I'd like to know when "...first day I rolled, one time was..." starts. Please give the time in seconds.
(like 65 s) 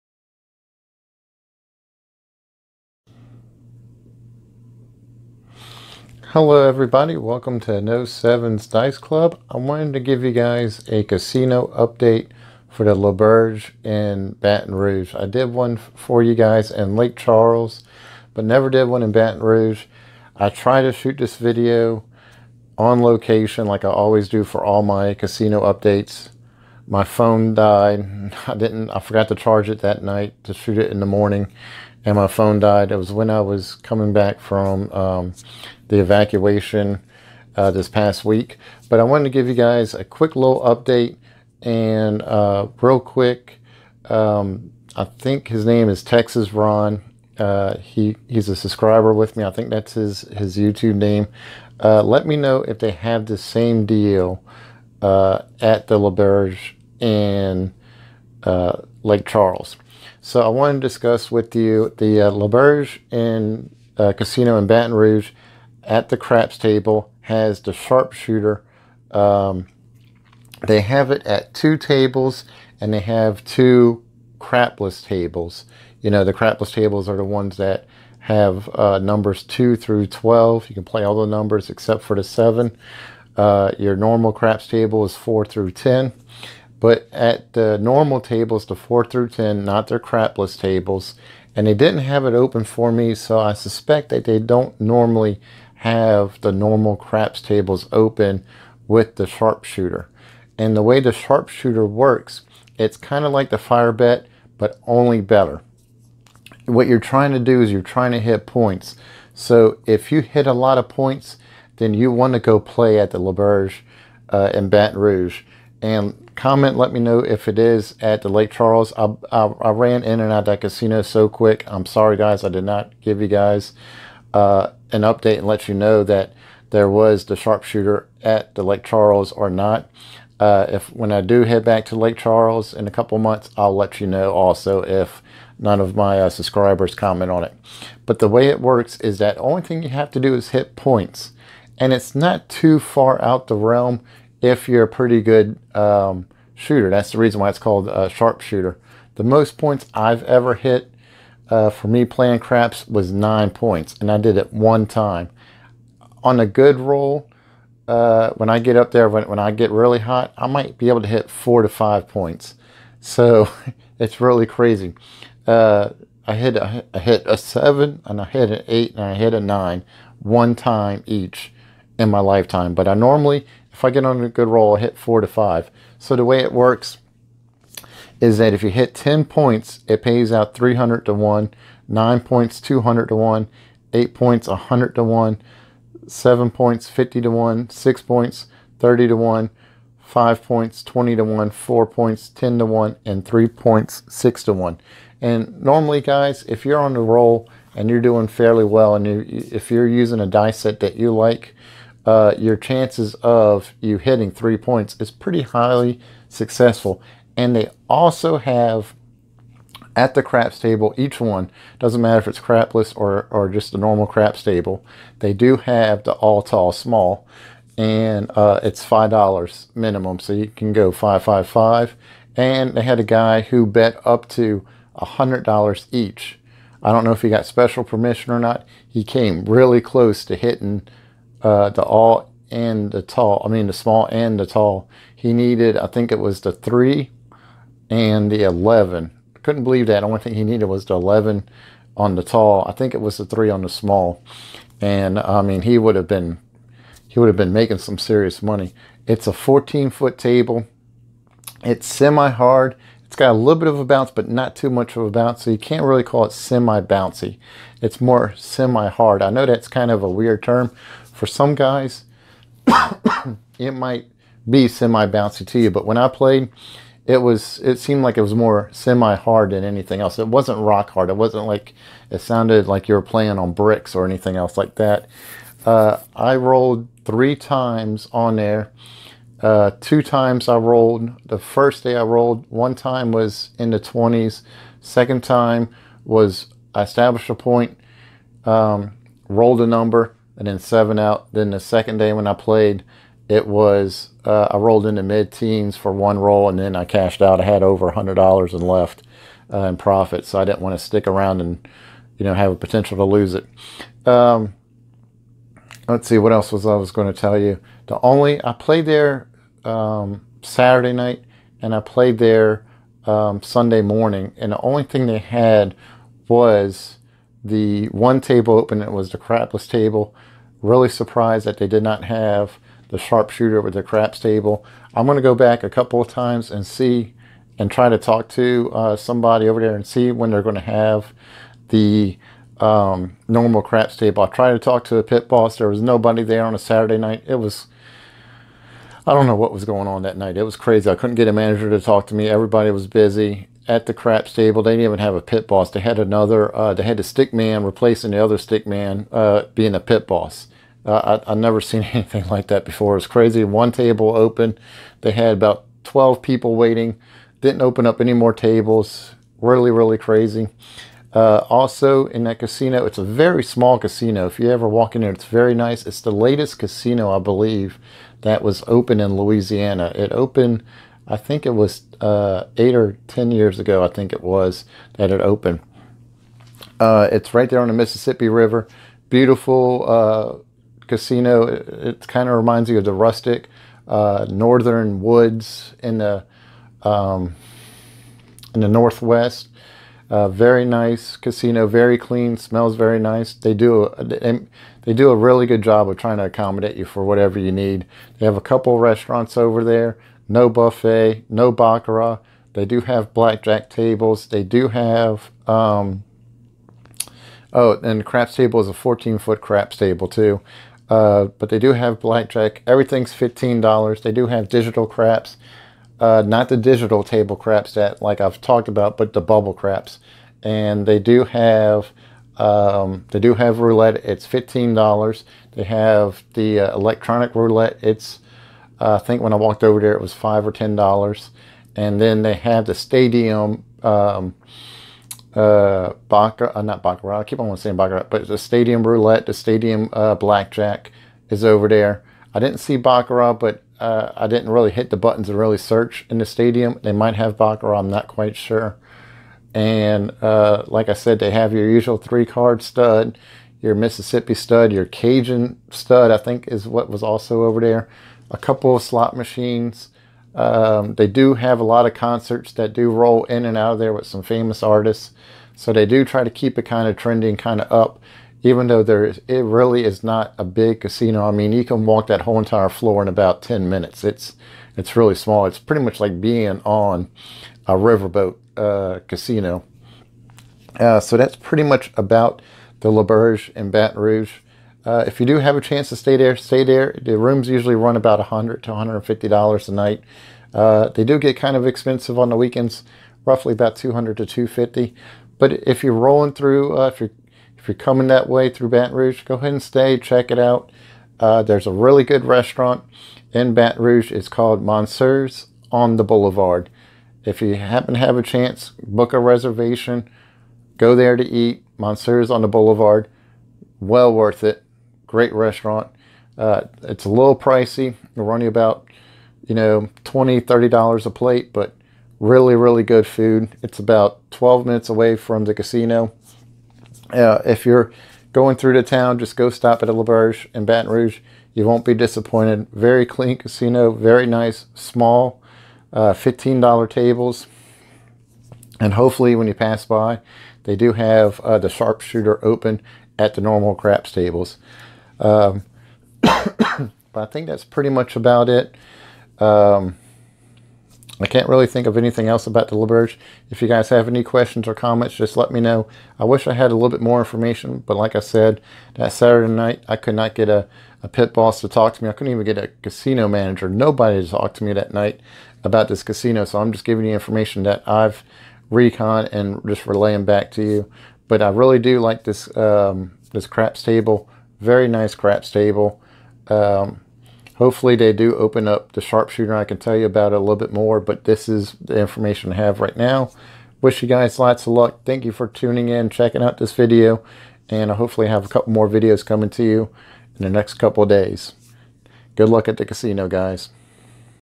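281 s.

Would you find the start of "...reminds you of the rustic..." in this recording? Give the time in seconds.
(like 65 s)
382 s.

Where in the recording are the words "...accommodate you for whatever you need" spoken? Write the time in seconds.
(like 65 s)
396 s.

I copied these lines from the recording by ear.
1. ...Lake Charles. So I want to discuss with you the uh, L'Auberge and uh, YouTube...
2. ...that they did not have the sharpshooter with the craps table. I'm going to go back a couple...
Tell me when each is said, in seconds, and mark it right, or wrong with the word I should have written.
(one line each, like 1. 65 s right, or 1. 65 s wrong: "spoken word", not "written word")
1. 59 s wrong: "Casino", not "YouTube"
2. 321 s right.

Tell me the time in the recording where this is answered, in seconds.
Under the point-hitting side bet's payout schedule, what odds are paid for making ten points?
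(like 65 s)
180 s.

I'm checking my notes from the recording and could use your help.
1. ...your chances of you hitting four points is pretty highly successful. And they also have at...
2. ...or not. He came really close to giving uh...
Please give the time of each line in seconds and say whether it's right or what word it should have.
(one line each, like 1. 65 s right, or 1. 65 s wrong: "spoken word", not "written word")
1. 202 s wrong: "three", not "four"
2. 228 s wrong: "hitting", not "giving".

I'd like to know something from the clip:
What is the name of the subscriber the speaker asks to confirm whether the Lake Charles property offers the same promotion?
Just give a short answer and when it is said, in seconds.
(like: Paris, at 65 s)
Texas Ron, at 46 s.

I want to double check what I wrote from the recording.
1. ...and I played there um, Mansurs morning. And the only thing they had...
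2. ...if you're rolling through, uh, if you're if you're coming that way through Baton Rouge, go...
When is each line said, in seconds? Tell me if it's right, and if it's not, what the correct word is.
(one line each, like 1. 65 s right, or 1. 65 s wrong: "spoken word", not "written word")
1. 311 s wrong: "Sunday", not "Mansurs"
2. 495 s right.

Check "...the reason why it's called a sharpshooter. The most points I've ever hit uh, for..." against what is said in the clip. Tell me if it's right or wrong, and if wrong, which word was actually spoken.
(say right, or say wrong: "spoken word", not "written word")
right.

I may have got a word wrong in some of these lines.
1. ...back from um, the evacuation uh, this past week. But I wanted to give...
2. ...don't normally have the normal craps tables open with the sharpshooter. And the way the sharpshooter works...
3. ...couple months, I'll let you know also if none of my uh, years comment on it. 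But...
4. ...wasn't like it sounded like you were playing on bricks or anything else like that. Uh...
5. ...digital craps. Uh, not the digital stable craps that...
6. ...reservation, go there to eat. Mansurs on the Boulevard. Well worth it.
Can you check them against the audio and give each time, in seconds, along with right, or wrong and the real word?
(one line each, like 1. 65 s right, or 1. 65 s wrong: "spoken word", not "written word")
1. 34 s right
2. 94 s right
3. 132 s wrong: "subscribers", not "years"
4. 271 s right
5. 414 s wrong: "table", not "stable"
6. 509 s right.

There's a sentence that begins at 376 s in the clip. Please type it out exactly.
Uh, it's right there on the Mississippi River.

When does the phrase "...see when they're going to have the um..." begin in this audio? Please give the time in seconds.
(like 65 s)
329 s.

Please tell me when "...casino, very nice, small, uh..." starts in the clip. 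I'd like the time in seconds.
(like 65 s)
533 s.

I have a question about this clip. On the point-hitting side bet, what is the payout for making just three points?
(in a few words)
6 to 1.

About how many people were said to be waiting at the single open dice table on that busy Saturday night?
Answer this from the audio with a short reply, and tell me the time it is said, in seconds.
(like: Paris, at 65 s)
12, at 355 s.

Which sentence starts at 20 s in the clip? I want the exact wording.
I try to shoot this video on location like I always do for all my casino updates.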